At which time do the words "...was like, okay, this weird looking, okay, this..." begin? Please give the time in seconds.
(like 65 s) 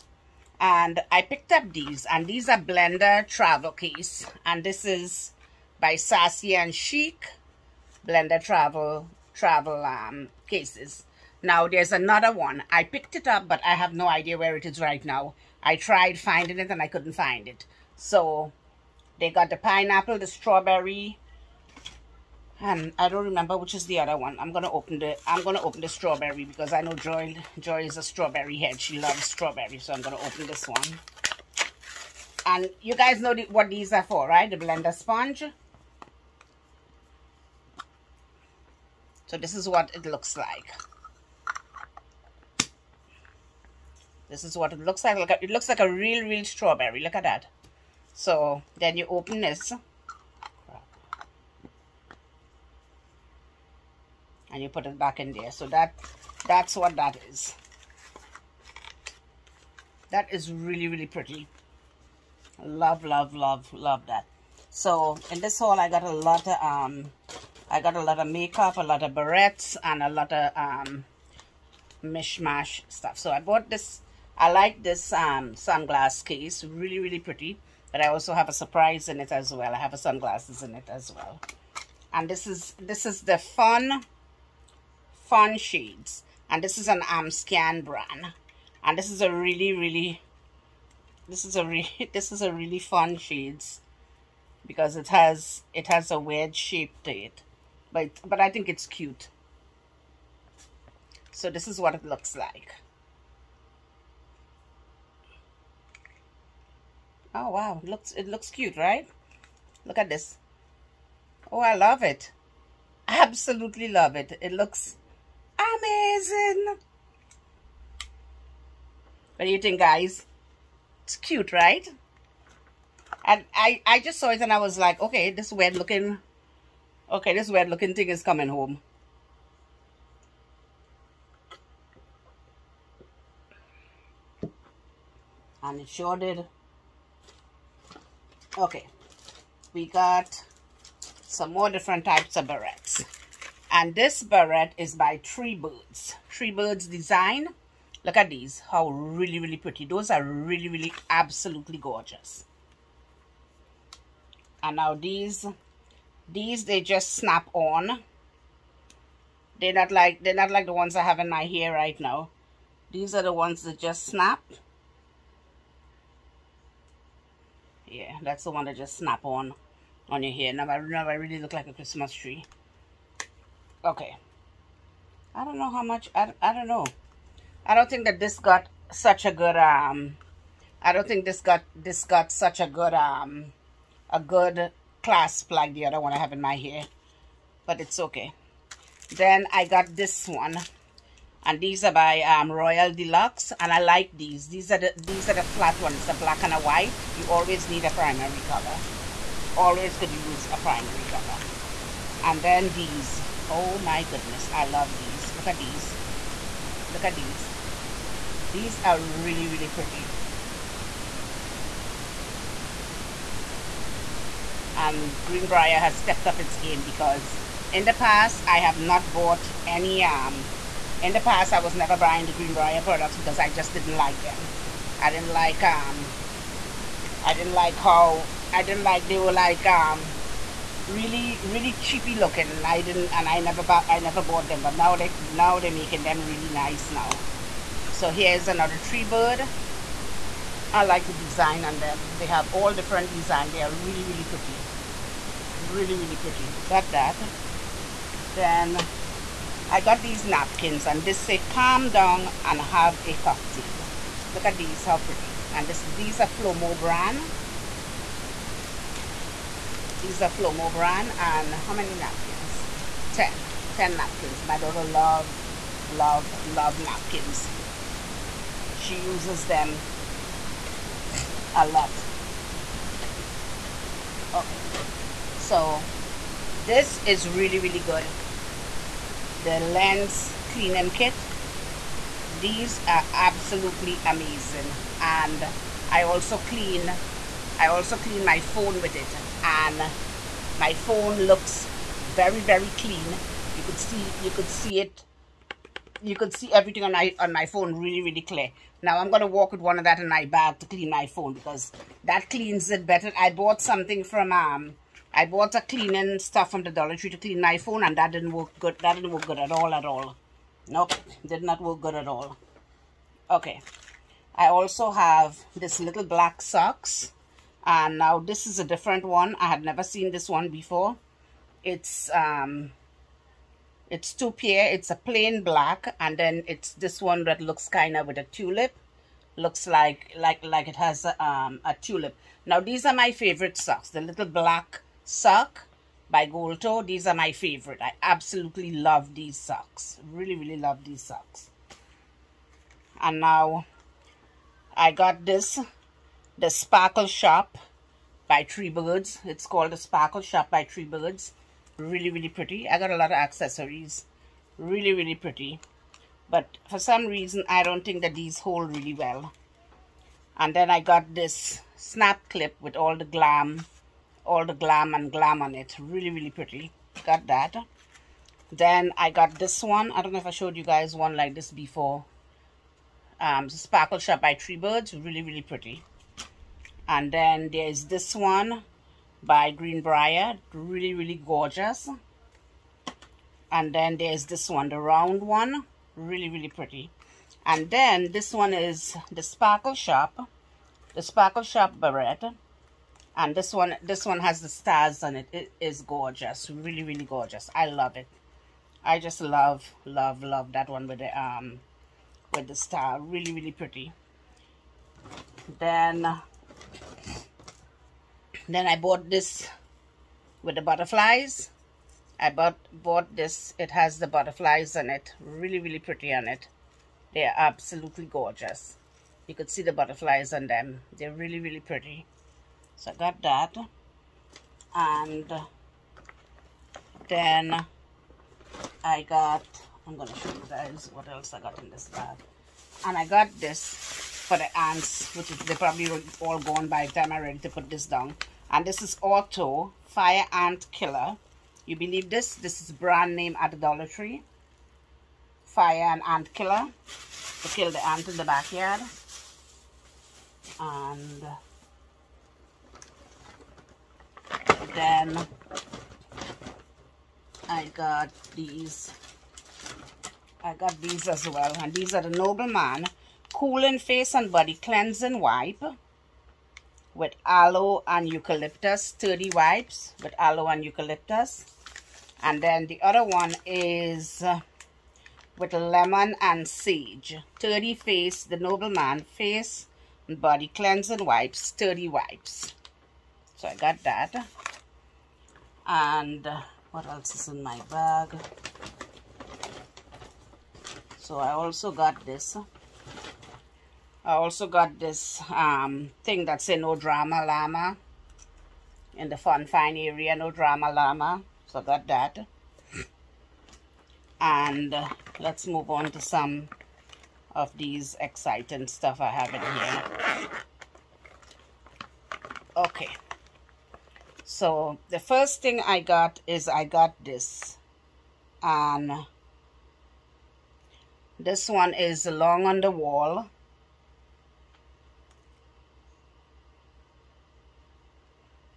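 124 s.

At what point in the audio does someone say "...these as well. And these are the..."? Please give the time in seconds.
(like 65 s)
460 s.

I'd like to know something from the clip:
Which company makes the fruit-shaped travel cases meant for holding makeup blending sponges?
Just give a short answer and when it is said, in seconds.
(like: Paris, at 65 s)
Sassy and Chic, at 5 s.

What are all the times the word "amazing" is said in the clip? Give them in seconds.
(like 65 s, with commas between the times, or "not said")
115 s, 284 s.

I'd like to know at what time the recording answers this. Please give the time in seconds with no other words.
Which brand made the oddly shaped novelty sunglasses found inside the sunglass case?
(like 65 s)
87 s.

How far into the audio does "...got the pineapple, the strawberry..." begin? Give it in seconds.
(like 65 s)
19 s.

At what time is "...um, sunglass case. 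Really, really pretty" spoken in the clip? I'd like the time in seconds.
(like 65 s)
75 s.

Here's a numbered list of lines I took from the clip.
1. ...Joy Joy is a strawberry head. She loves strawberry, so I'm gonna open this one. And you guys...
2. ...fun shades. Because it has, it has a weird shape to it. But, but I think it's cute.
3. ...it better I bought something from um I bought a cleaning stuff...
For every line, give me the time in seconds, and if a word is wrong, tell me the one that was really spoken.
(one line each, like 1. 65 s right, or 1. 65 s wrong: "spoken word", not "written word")
1. 26 s right
2. 92 s right
3. 302 s right.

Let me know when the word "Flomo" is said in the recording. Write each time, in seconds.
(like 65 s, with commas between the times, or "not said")
256 s, 260 s.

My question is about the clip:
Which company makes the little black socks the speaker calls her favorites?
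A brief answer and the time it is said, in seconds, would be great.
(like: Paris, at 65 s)
Gold Toe, at 336 s.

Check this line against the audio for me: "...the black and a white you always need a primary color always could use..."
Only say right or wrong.
right.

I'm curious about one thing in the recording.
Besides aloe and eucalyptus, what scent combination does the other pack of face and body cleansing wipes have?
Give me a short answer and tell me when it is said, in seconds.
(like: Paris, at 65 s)
lemon and sage, at 475 s.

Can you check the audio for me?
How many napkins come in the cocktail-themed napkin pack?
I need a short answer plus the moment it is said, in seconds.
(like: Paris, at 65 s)
10, at 263 s.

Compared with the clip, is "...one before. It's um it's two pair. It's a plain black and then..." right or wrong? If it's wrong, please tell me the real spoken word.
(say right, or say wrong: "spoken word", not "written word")
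right.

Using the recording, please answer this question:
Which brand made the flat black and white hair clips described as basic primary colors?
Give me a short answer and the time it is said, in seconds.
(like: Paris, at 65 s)
Royal Deluxe, at 192 s.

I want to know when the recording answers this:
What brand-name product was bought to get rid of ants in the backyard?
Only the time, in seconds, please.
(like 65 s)
439 s.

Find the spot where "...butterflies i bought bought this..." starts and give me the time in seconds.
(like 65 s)
410 s.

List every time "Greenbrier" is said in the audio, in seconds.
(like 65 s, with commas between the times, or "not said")
215 s, 222 s, 379 s.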